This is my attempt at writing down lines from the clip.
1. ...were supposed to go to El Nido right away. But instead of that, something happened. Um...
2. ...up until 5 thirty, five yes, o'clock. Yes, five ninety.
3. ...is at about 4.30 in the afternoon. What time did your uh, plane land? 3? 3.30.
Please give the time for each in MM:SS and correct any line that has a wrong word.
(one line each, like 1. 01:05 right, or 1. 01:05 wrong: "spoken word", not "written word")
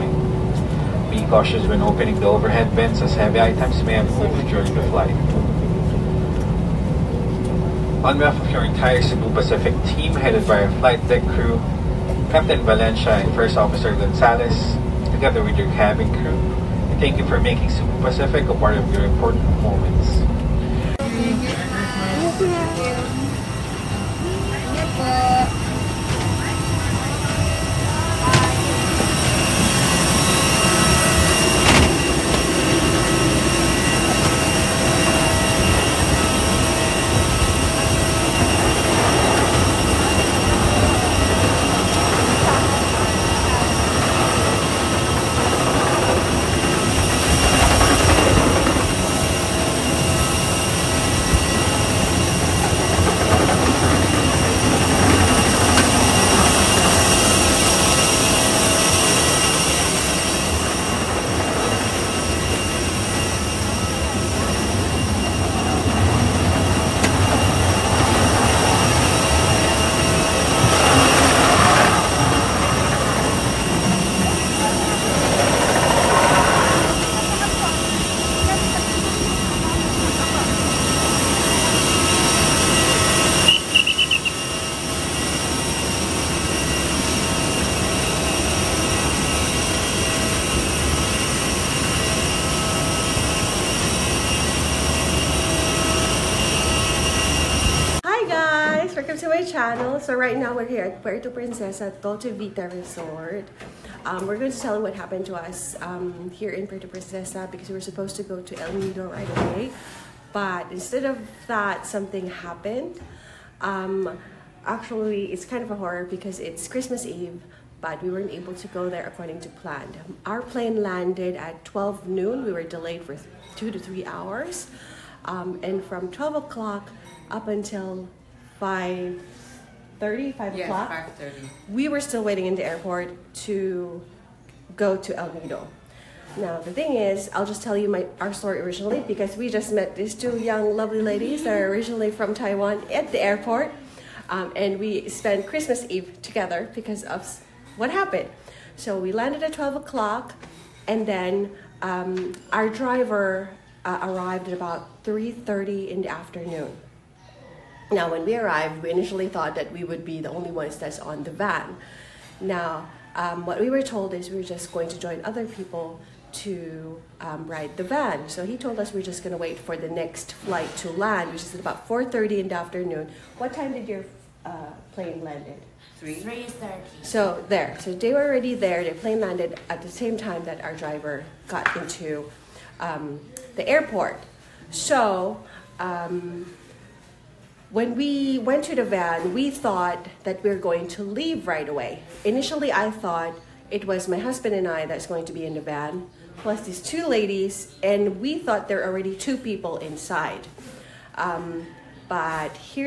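1. 01:47 right
2. 02:07 wrong: "thirty", not "ninety"
3. 02:51 right.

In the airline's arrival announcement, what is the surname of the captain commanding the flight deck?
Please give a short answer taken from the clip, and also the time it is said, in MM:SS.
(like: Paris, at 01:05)
Valencia, at 00:12.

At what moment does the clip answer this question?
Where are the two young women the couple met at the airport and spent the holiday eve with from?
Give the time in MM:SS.
02:22.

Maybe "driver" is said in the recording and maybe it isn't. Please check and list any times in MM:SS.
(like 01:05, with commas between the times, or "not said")
02:32, 03:00.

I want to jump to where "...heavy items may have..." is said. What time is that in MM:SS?
00:03.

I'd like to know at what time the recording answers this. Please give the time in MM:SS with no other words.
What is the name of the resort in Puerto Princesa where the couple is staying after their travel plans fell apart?
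01:42.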